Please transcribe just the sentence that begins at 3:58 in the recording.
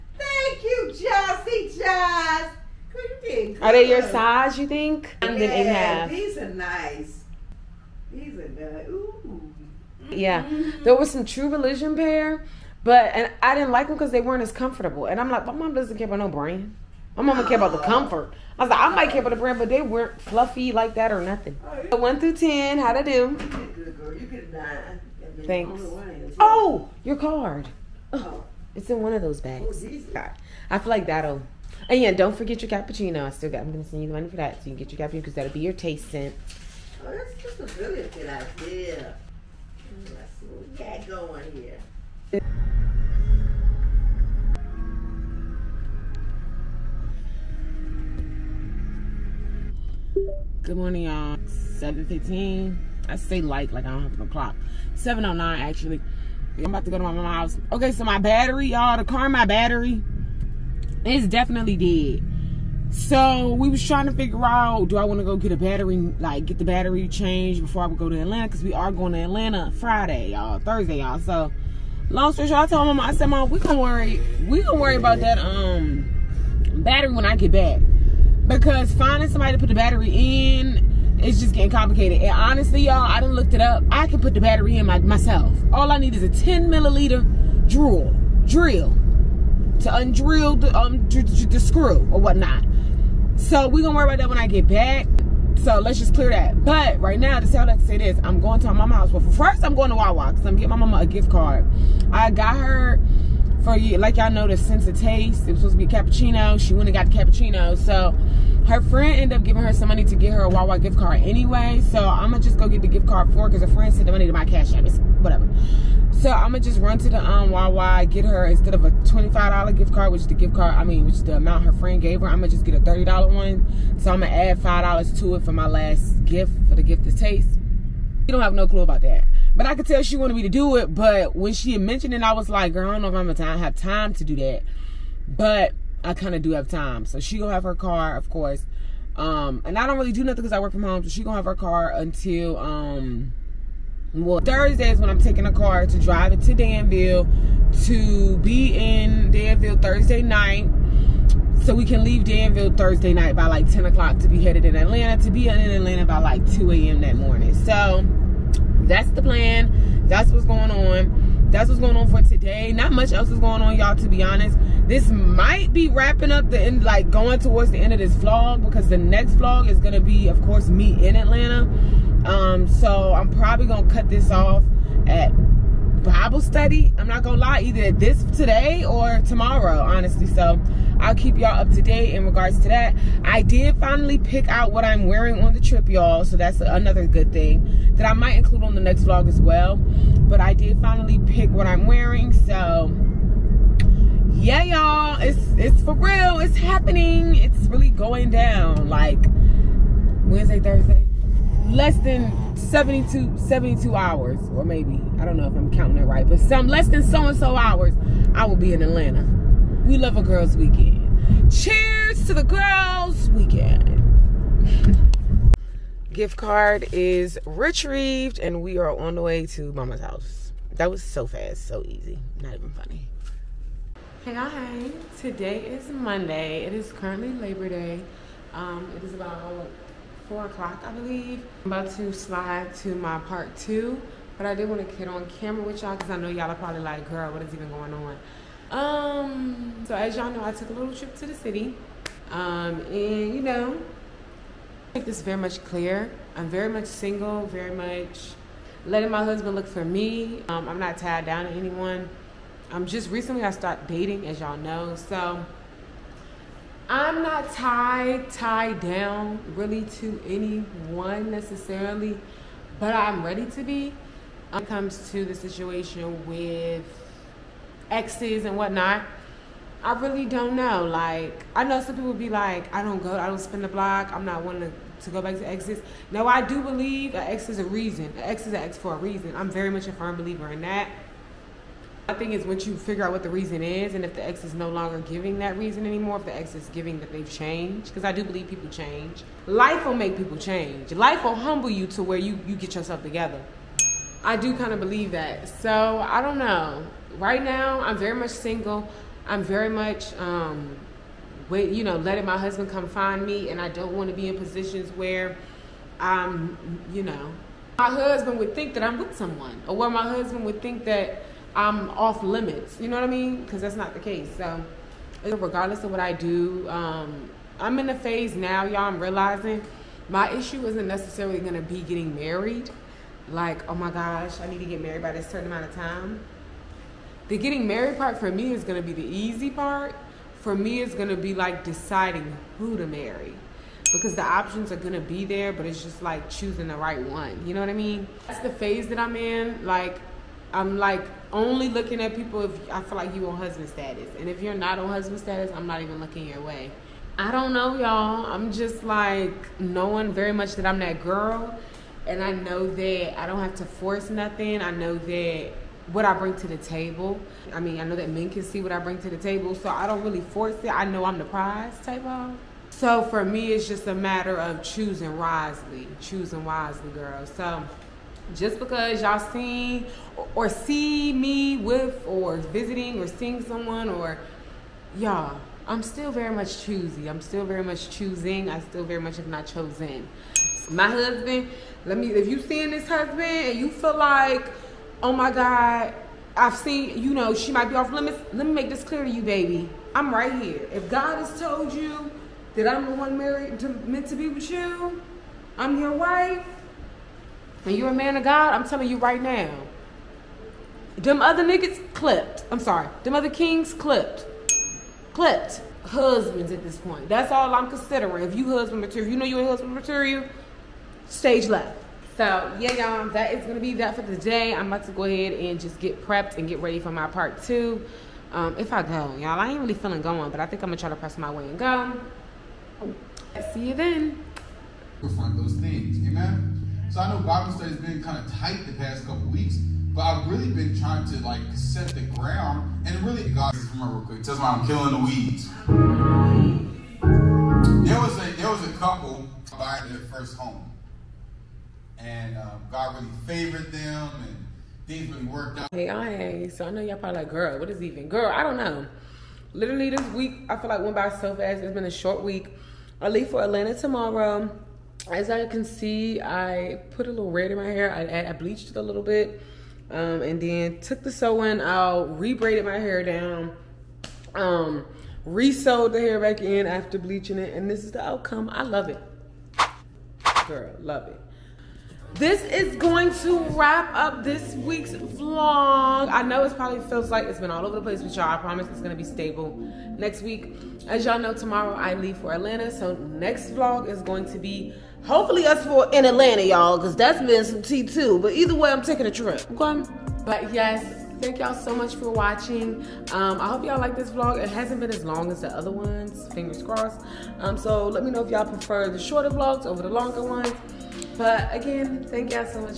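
Um, so as y'all know, I took a little trip to the city.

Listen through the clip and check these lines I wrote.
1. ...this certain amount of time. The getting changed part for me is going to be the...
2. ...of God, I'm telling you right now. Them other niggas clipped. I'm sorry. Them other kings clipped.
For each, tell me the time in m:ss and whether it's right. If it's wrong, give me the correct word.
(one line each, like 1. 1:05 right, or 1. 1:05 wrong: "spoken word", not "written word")
1. 5:25 wrong: "married", not "changed"
2. 6:38 right.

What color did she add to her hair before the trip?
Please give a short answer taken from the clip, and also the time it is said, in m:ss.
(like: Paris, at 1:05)
Red, at 7:37.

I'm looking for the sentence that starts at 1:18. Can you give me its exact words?
Because finding somebody to put the battery in is just getting complicated.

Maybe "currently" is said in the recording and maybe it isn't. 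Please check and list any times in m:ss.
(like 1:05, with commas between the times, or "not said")
3:46.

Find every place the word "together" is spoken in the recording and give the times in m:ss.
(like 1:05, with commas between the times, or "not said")
4:53.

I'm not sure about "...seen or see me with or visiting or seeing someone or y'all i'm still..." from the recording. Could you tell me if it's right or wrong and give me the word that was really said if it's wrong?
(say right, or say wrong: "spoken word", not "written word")
right.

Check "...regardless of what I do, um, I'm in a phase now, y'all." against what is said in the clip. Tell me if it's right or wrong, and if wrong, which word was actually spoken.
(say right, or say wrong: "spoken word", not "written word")
right.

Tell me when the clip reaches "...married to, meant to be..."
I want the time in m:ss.
6:33.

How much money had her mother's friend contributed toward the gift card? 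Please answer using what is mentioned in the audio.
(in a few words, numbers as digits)
$25.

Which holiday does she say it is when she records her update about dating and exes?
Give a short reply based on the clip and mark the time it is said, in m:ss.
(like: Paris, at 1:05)
Labor Day, at 3:47.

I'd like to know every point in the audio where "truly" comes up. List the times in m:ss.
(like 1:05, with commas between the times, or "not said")
not said.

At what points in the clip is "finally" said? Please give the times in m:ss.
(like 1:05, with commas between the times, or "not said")
3:03, 3:10.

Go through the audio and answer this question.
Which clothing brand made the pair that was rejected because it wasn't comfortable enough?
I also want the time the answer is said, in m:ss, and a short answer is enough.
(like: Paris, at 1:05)
True Religion, at 0:11.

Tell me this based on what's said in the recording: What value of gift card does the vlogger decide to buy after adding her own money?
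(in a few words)
$30.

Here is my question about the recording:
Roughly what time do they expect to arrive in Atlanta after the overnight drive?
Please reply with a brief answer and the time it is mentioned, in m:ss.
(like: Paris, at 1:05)
2 a.m., at 2:36.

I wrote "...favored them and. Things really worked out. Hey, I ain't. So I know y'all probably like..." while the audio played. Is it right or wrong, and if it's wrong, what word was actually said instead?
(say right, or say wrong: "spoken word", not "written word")
right.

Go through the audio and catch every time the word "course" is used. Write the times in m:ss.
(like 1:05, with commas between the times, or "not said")
2:18, 2:50.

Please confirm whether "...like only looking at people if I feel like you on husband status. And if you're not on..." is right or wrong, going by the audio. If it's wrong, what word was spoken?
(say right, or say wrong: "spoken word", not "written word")
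right.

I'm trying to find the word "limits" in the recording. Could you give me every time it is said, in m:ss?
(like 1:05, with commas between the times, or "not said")
5:12, 6:27.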